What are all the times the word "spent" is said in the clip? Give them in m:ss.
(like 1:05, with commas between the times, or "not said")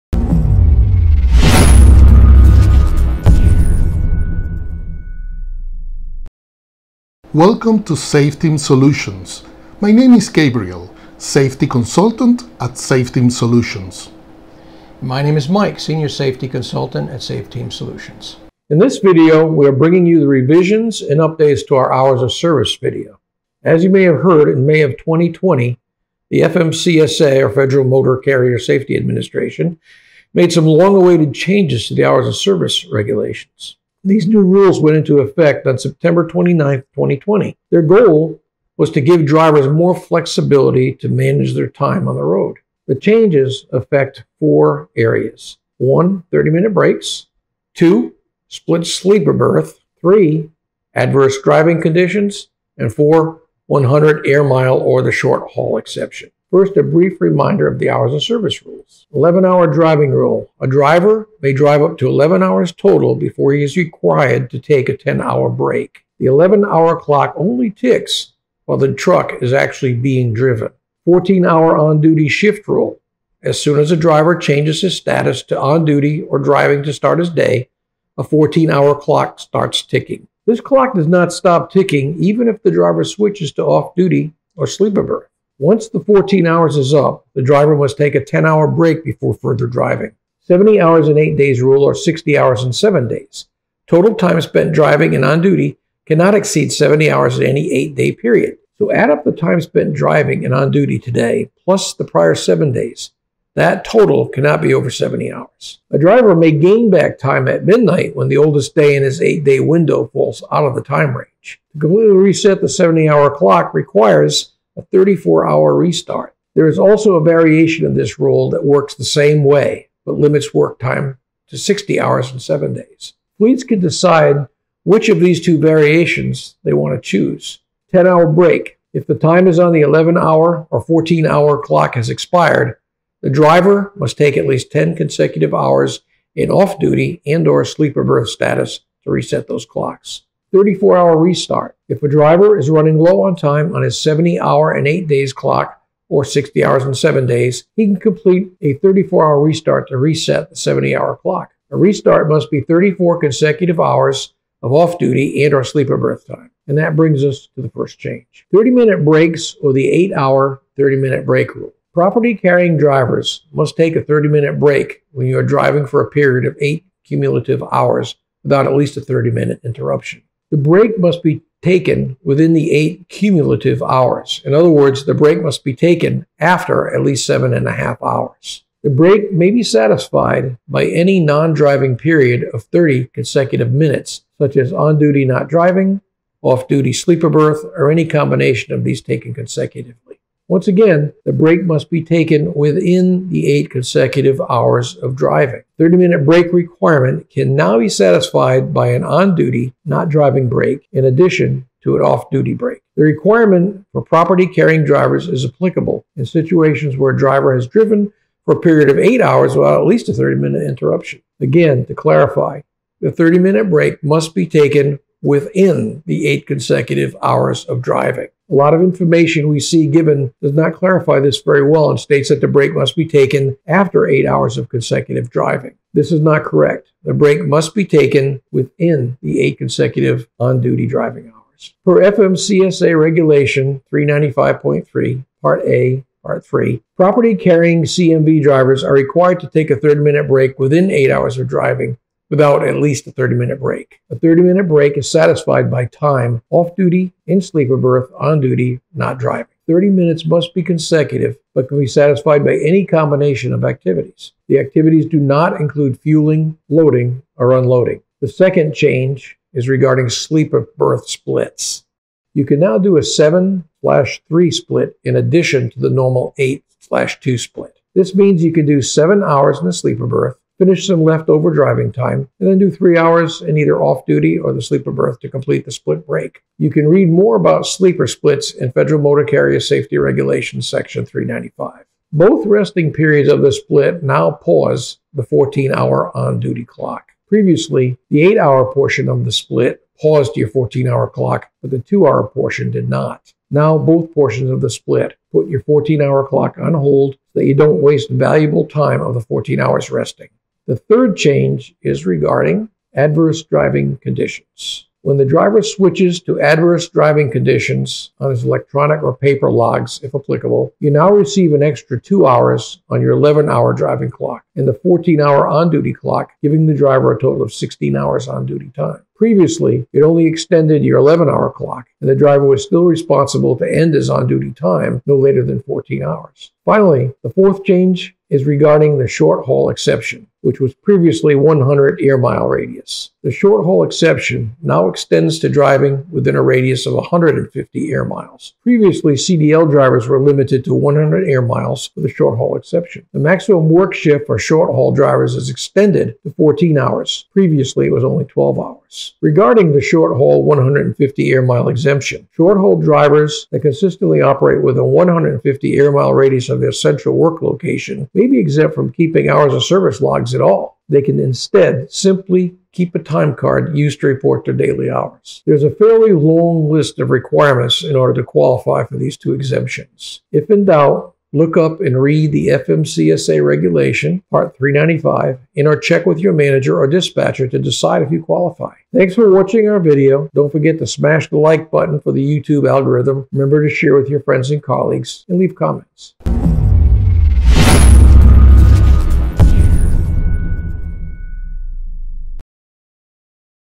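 1:34, 1:39.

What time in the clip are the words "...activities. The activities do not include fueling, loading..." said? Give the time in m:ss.
4:13.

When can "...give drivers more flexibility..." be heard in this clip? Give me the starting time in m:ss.
0:39.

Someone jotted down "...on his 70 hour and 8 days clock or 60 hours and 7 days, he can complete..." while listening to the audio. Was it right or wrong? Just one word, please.
right.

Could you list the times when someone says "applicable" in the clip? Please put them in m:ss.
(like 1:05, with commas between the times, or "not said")
3:25, 5:10.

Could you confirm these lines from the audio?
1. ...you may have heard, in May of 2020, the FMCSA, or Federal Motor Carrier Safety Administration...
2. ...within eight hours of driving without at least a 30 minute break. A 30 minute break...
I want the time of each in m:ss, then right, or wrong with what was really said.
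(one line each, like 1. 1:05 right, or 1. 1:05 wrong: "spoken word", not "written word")
1. 0:23 right
2. 4:00 right.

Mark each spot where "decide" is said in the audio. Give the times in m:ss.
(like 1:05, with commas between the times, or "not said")
2:03, 6:17.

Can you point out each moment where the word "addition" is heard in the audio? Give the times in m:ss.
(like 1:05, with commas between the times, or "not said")
3:21, 4:25.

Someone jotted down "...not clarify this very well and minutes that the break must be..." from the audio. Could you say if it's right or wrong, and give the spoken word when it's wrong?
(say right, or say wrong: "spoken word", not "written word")
wrong: "states", not "minutes".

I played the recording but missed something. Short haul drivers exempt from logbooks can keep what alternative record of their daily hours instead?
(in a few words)
a time card.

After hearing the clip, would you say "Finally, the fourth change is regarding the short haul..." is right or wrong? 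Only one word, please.
right.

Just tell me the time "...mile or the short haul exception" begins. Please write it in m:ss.
0:54.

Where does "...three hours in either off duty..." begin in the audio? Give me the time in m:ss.
4:32.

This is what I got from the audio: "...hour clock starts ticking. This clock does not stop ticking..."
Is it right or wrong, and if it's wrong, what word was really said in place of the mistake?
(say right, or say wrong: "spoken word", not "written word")
right.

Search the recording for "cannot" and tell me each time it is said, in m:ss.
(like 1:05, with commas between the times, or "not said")
1:36, 1:44.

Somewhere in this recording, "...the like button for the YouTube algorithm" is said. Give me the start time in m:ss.
6:21.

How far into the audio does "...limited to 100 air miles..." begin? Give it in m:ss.
5:40.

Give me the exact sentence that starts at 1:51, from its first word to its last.
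To completely reset the 70 hour clock requires a 34 hour restart.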